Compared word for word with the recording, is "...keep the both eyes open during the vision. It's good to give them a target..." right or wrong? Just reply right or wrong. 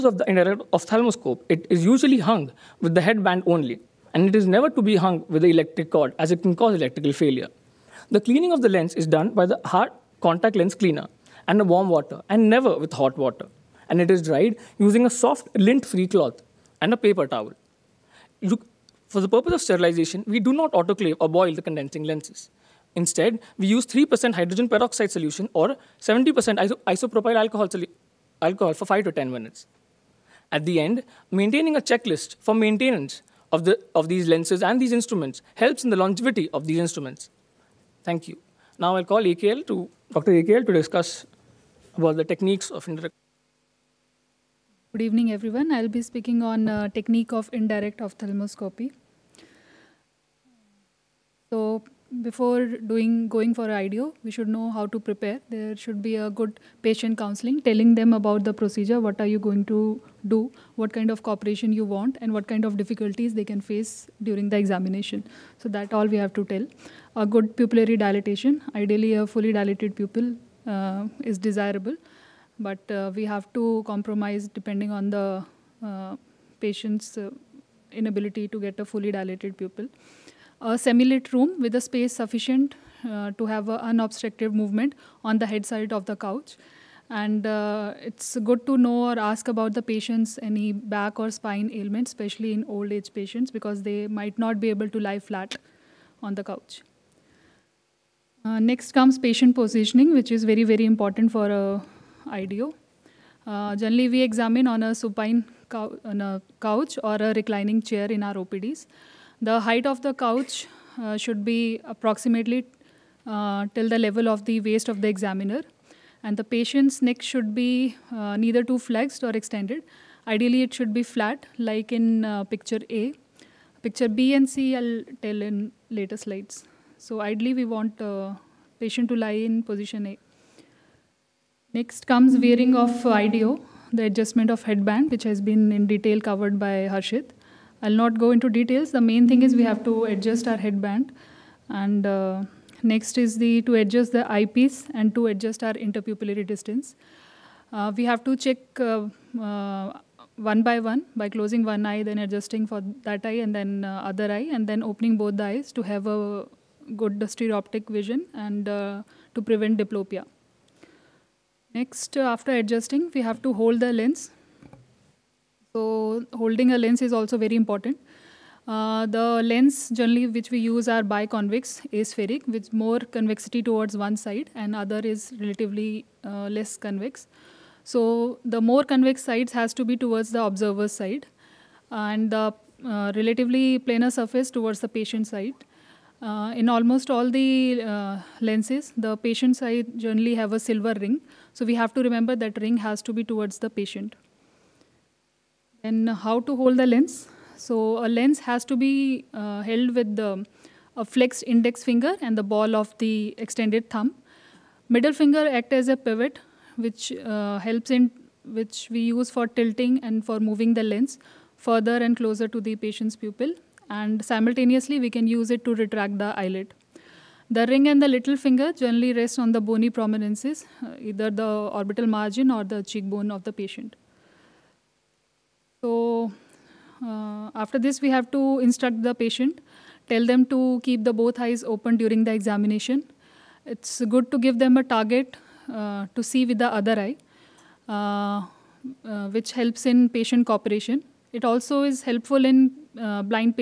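wrong.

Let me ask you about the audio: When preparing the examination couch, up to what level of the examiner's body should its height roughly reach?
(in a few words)
The waist.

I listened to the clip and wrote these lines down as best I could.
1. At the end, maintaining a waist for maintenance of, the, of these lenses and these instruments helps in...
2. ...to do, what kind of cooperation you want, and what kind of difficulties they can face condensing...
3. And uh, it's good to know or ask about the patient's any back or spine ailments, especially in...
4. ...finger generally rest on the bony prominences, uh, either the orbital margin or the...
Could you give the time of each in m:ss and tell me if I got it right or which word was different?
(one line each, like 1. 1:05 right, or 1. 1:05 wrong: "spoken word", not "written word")
1. 0:30 wrong: "checklist", not "waist"
2. 0:59 wrong: "during", not "condensing"
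3. 1:27 right
4. 3:38 right.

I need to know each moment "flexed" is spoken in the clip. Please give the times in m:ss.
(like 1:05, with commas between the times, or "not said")
1:58, 3:21.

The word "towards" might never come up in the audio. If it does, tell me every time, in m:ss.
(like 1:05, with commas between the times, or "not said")
2:53, 2:59, 3:04, 3:13.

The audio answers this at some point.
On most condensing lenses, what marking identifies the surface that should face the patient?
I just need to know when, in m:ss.
3:10.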